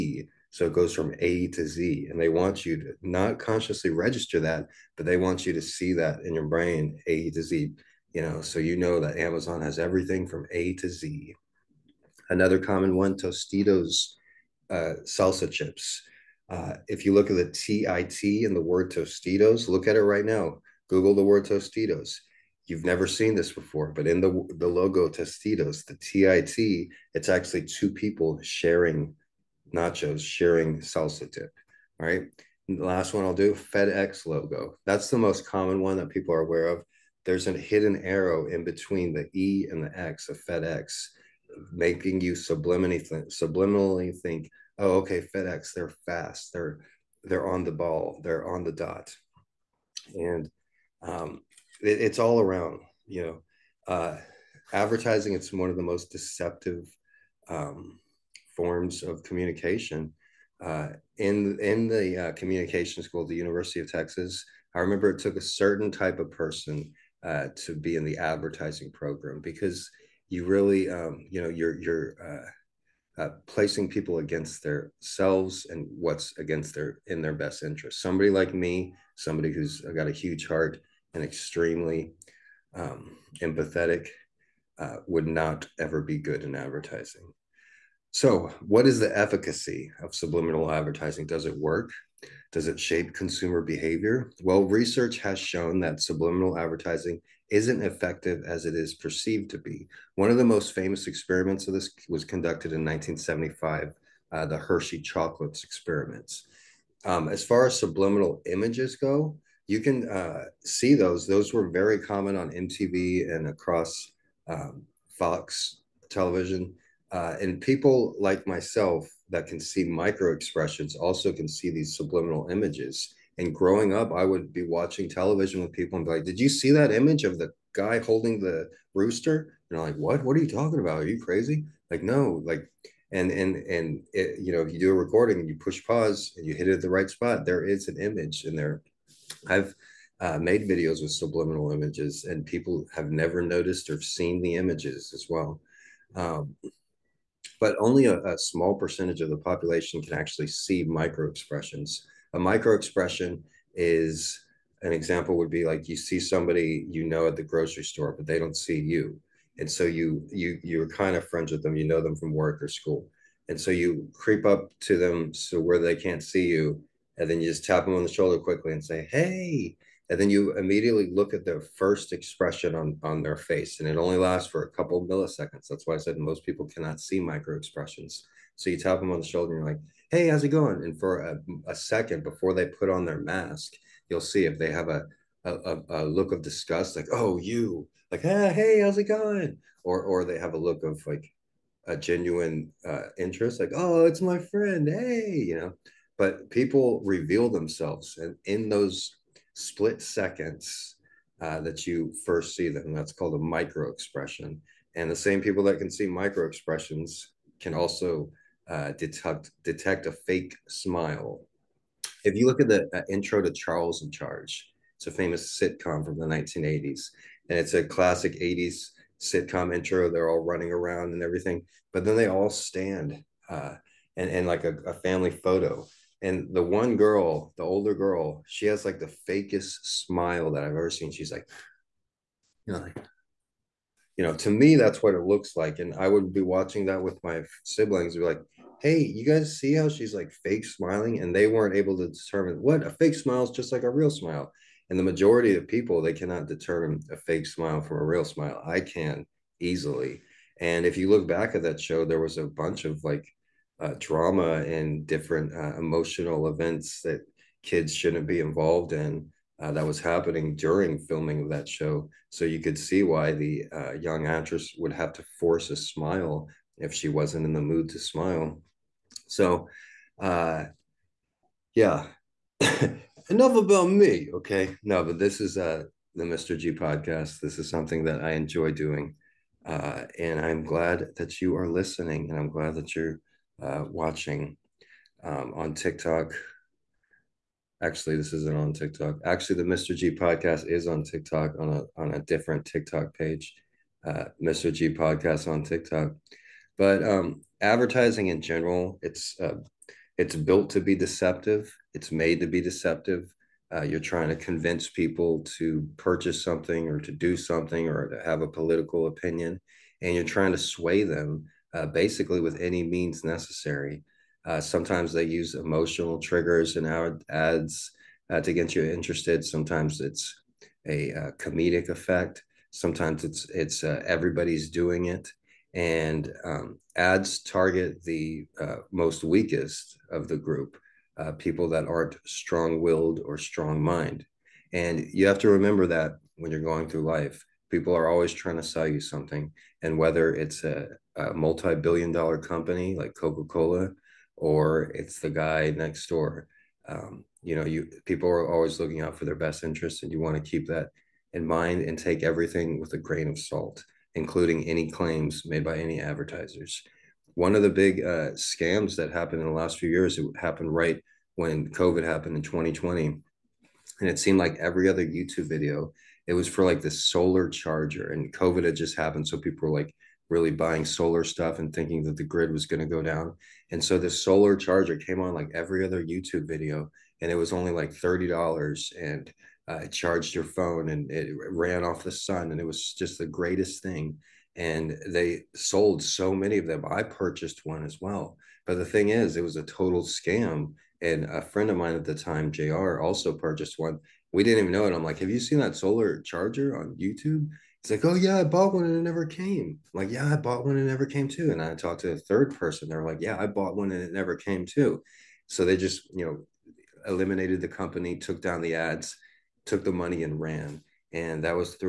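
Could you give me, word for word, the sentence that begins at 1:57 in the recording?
Uh, and people like myself that can see micro expressions also can see these subliminal images.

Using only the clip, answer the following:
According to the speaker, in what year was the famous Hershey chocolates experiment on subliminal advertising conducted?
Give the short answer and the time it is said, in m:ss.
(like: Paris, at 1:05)
1975, at 1:42.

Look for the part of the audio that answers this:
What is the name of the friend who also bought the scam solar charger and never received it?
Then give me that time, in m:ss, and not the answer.
6:32.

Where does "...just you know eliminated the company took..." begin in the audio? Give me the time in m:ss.
6:45.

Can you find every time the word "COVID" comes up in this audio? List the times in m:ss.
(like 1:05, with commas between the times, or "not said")
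6:01, 6:08.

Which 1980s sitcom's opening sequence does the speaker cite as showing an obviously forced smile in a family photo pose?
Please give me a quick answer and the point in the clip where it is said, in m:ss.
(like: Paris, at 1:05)
Charles in Charge, at 3:33.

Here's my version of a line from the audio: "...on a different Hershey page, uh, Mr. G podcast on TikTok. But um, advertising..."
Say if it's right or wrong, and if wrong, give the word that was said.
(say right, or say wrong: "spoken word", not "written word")
wrong: "TikTok", not "Hershey".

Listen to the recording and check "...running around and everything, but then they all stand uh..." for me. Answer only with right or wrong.
right.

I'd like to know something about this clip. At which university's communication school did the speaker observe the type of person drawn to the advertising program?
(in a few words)
University of Texas.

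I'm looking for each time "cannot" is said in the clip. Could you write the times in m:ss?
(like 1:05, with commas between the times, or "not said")
2:56, 4:06.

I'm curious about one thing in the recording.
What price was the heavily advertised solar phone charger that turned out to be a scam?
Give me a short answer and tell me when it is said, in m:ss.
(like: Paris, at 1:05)
$30, at 6:17.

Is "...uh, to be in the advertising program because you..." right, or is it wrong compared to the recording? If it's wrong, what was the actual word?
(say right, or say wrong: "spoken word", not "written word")
right.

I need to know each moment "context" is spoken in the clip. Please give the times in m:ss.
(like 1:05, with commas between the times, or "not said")
not said.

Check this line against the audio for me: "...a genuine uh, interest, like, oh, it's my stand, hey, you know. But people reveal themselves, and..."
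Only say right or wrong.
wrong.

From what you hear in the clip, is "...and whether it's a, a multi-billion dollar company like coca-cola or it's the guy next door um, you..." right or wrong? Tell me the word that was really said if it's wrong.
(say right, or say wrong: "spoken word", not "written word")
right.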